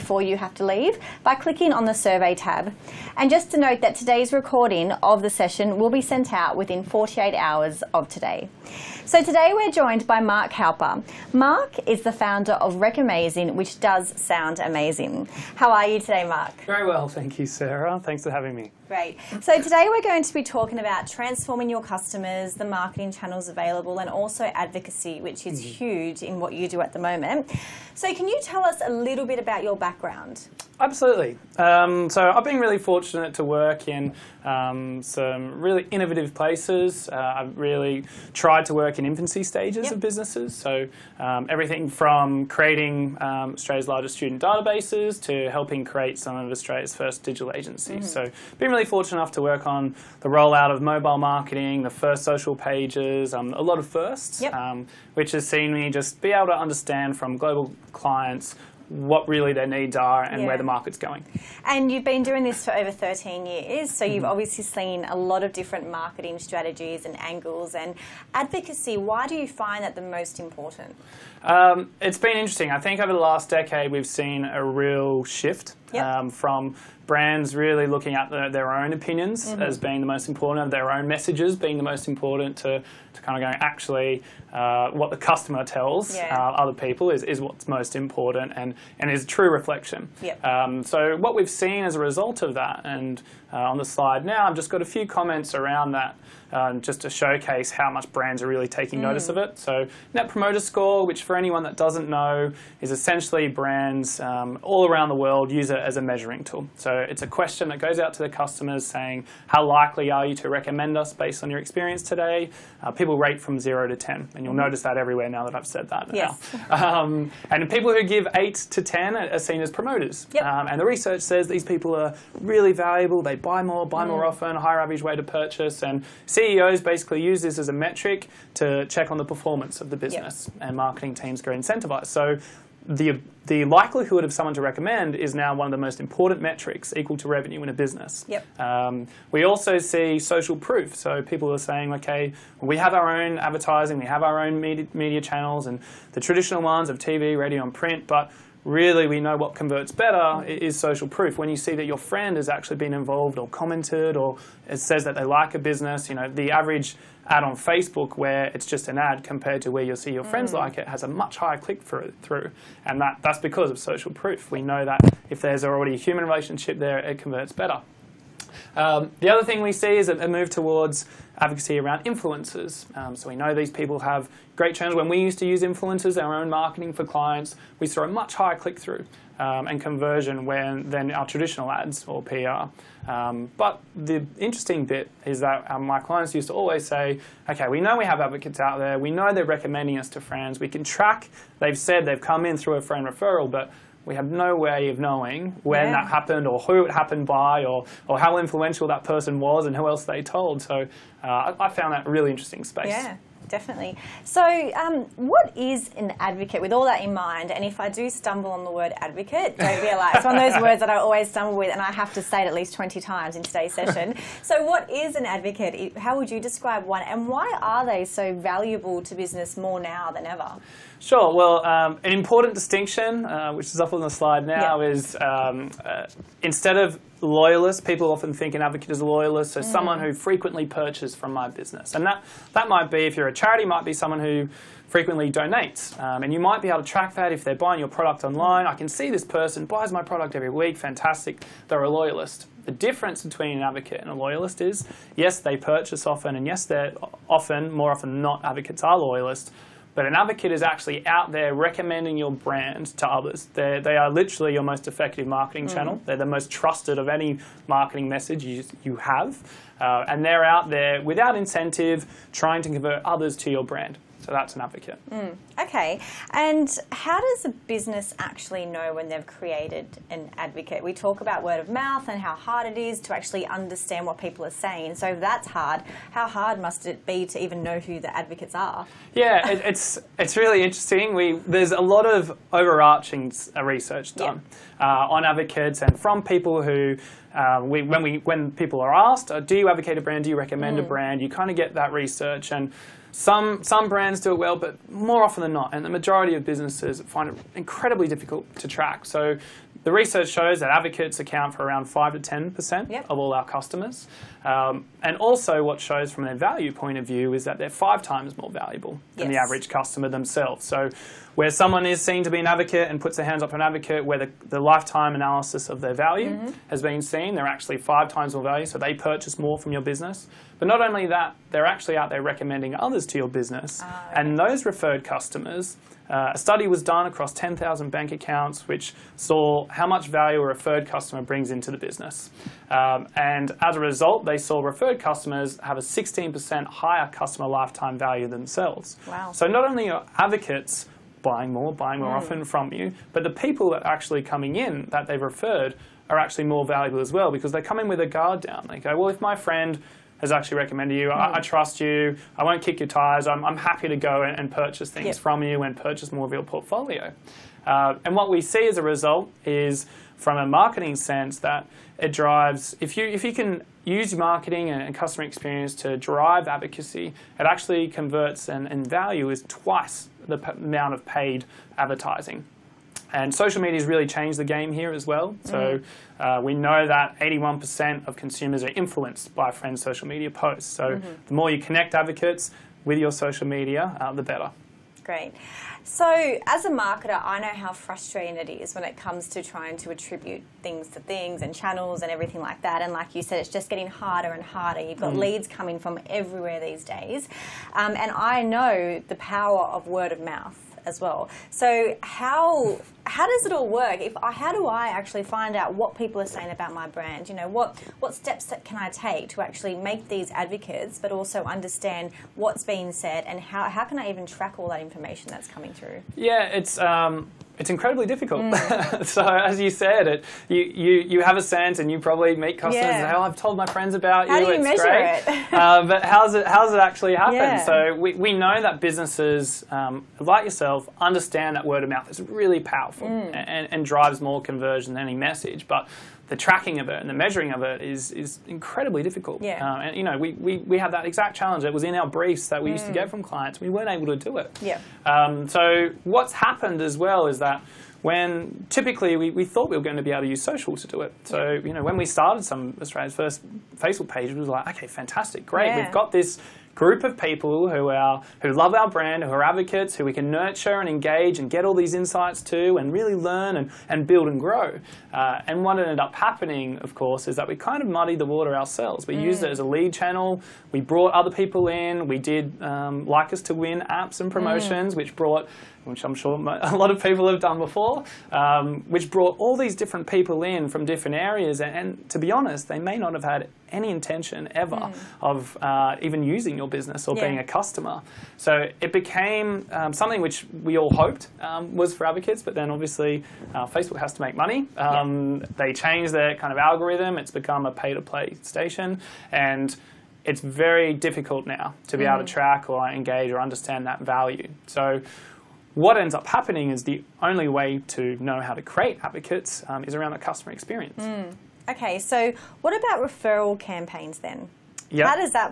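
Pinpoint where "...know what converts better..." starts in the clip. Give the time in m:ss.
2:29.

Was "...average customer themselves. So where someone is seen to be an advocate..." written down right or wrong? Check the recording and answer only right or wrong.
right.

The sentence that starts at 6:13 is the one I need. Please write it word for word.
And social media has really changed the game here as well.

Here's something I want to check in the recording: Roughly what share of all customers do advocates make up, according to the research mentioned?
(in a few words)
5 to 10%.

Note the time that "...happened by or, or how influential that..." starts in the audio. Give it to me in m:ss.
3:16.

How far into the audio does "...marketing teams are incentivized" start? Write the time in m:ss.
2:10.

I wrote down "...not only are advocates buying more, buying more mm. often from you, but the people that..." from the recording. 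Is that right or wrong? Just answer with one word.
right.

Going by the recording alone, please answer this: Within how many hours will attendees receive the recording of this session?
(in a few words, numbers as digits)
48.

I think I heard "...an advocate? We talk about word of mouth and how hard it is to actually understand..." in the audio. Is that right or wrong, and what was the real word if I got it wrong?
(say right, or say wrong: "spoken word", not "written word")
right.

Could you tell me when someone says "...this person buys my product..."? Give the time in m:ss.
3:59.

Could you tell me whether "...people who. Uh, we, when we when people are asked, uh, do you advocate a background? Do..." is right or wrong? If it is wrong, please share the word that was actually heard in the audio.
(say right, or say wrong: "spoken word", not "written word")
wrong: "brand", not "background".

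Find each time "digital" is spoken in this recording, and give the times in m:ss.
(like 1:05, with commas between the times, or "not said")
0:47.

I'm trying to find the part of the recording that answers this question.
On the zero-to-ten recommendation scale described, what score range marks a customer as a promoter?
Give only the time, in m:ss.
1:58.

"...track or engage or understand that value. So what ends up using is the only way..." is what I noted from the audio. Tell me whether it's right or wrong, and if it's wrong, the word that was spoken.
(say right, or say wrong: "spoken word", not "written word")
wrong: "happening", not "using".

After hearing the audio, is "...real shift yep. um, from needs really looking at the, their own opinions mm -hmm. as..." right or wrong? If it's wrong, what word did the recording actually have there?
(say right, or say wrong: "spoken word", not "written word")
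wrong: "brands", not "needs".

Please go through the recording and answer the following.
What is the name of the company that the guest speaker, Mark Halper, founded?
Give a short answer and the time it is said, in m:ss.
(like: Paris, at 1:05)
Recamazing, at 0:12.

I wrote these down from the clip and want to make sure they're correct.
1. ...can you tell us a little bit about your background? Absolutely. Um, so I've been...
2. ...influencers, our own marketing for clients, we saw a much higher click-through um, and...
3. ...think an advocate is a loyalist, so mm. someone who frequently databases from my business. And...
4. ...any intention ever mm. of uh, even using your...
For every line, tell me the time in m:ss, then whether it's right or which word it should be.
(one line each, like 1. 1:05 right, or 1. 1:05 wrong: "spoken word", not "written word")
1. 0:28 right
2. 2:55 right
3. 3:48 wrong: "purchases", not "databases"
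4. 8:03 right.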